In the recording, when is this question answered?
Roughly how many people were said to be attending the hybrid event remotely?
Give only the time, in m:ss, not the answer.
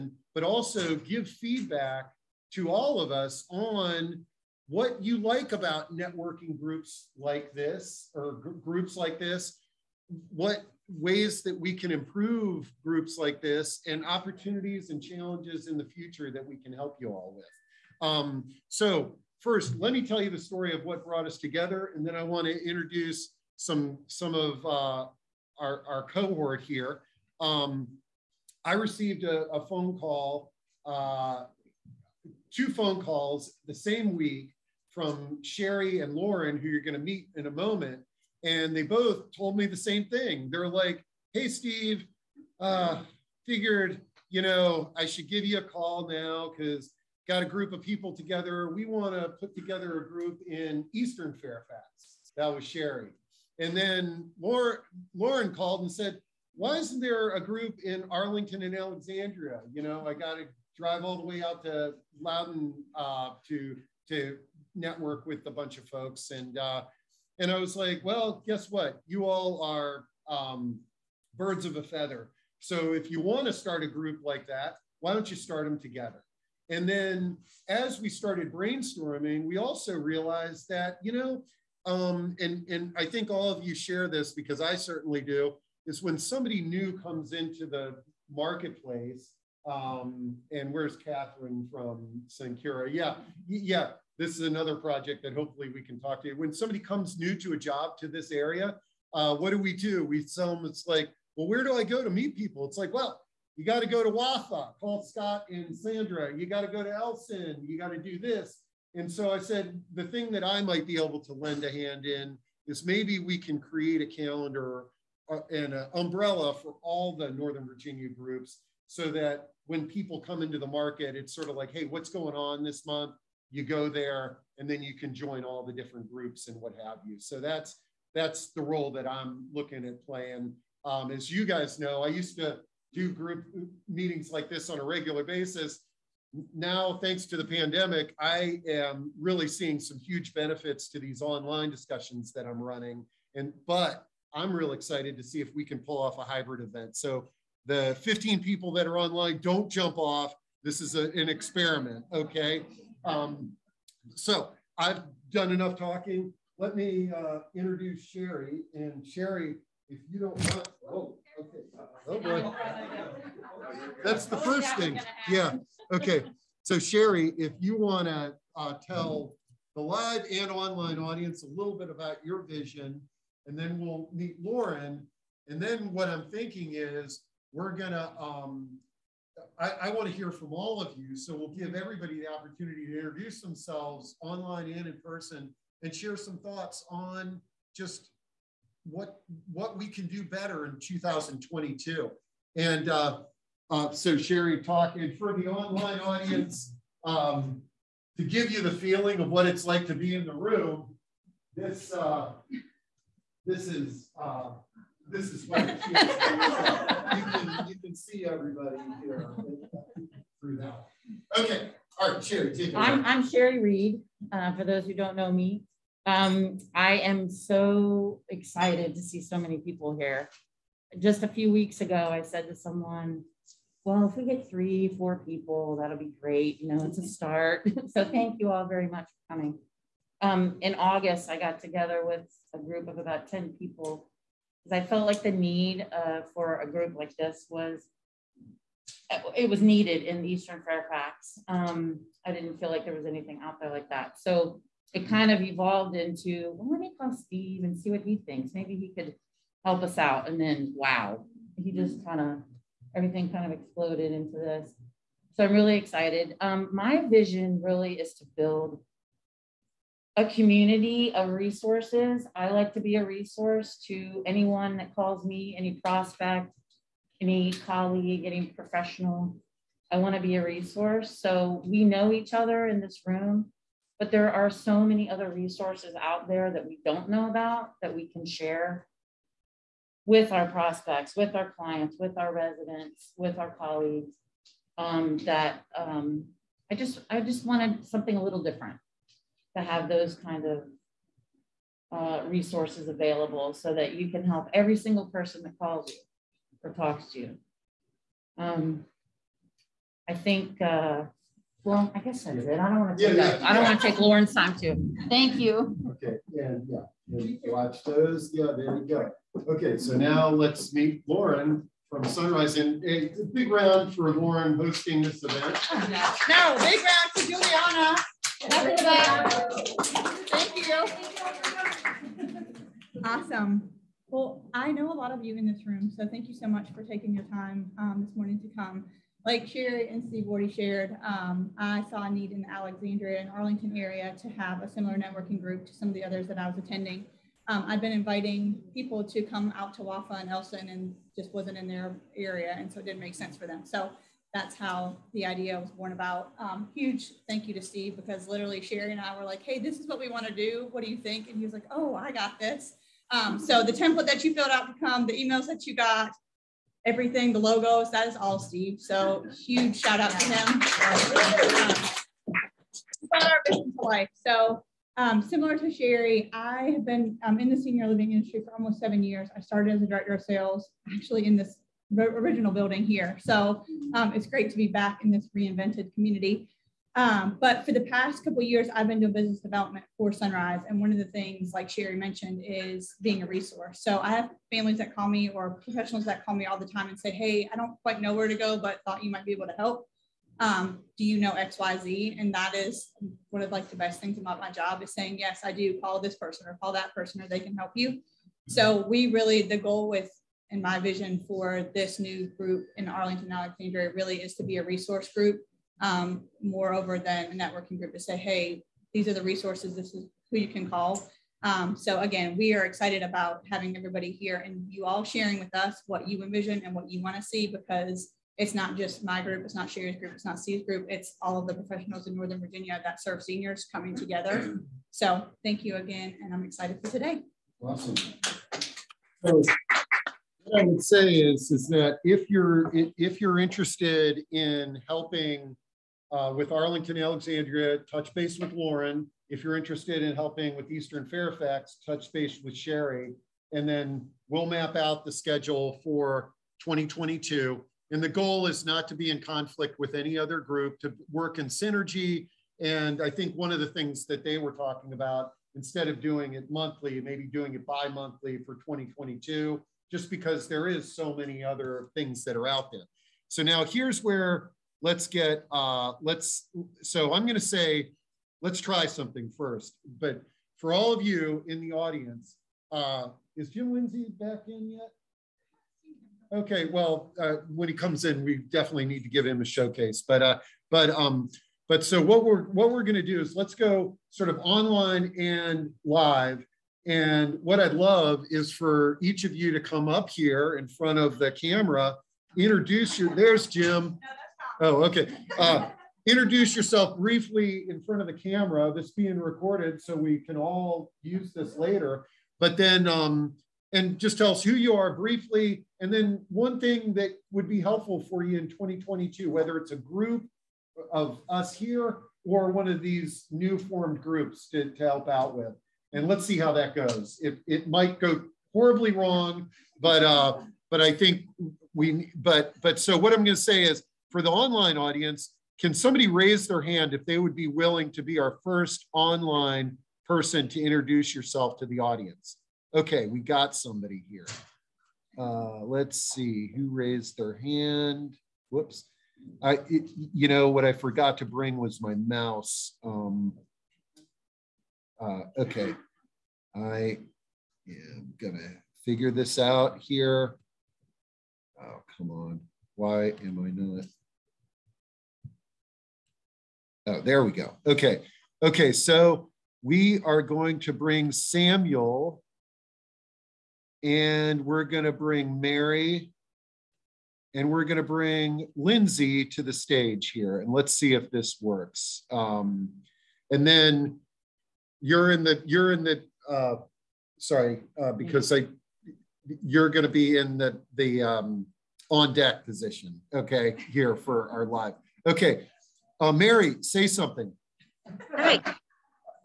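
2:28.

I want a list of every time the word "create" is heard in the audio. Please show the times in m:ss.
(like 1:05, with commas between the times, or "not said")
1:53.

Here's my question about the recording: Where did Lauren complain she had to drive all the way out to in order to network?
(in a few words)
Loudoun.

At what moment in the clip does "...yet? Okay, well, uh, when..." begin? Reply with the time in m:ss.
7:54.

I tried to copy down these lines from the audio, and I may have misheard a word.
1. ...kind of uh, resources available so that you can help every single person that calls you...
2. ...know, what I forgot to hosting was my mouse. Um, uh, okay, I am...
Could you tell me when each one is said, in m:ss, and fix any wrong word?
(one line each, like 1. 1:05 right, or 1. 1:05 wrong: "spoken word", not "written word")
1. 4:50 right
2. 9:00 wrong: "bring", not "hosting".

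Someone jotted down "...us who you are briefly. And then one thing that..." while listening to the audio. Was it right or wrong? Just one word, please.
right.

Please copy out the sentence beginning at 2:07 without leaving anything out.
So that's that's the role that I'm looking at playing.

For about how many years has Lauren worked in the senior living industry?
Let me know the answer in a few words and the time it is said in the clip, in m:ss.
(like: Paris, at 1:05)
7, at 6:08.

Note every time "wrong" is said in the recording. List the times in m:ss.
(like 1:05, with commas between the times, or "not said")
8:38.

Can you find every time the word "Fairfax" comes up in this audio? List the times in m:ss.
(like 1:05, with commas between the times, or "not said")
0:51, 4:00, 7:21.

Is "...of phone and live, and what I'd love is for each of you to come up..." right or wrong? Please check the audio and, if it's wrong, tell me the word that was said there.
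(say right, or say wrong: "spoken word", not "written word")
wrong: "online", not "phone".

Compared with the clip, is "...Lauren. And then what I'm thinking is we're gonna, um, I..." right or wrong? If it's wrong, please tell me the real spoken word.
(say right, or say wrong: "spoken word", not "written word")
right.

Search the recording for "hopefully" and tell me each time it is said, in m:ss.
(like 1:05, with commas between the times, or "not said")
1:35.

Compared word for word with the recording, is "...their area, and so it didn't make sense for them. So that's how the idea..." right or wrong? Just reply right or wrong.
right.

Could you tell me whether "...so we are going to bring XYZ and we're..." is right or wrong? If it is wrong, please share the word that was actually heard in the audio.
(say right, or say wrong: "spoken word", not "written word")
wrong: "Samuel", not "XYZ".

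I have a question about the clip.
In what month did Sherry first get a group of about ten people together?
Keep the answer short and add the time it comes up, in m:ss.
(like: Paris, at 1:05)
August, at 3:50.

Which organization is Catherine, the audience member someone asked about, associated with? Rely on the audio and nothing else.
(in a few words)
Sankura.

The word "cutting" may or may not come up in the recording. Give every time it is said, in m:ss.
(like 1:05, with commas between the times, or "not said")
not said.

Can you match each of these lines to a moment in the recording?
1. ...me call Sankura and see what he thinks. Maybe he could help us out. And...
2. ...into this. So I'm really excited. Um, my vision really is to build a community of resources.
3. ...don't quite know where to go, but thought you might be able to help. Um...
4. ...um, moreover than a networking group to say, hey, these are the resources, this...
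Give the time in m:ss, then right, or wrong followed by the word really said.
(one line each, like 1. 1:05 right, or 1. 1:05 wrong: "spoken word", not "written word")
1. 4:06 wrong: "Steve", not "Sankura"
2. 4:14 right
3. 6:27 right
4. 6:45 right.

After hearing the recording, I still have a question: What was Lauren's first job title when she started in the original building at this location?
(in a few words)
director of sales.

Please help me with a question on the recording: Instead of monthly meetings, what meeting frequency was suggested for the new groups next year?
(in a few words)
bi monthly.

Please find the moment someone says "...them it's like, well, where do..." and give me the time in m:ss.
1:40.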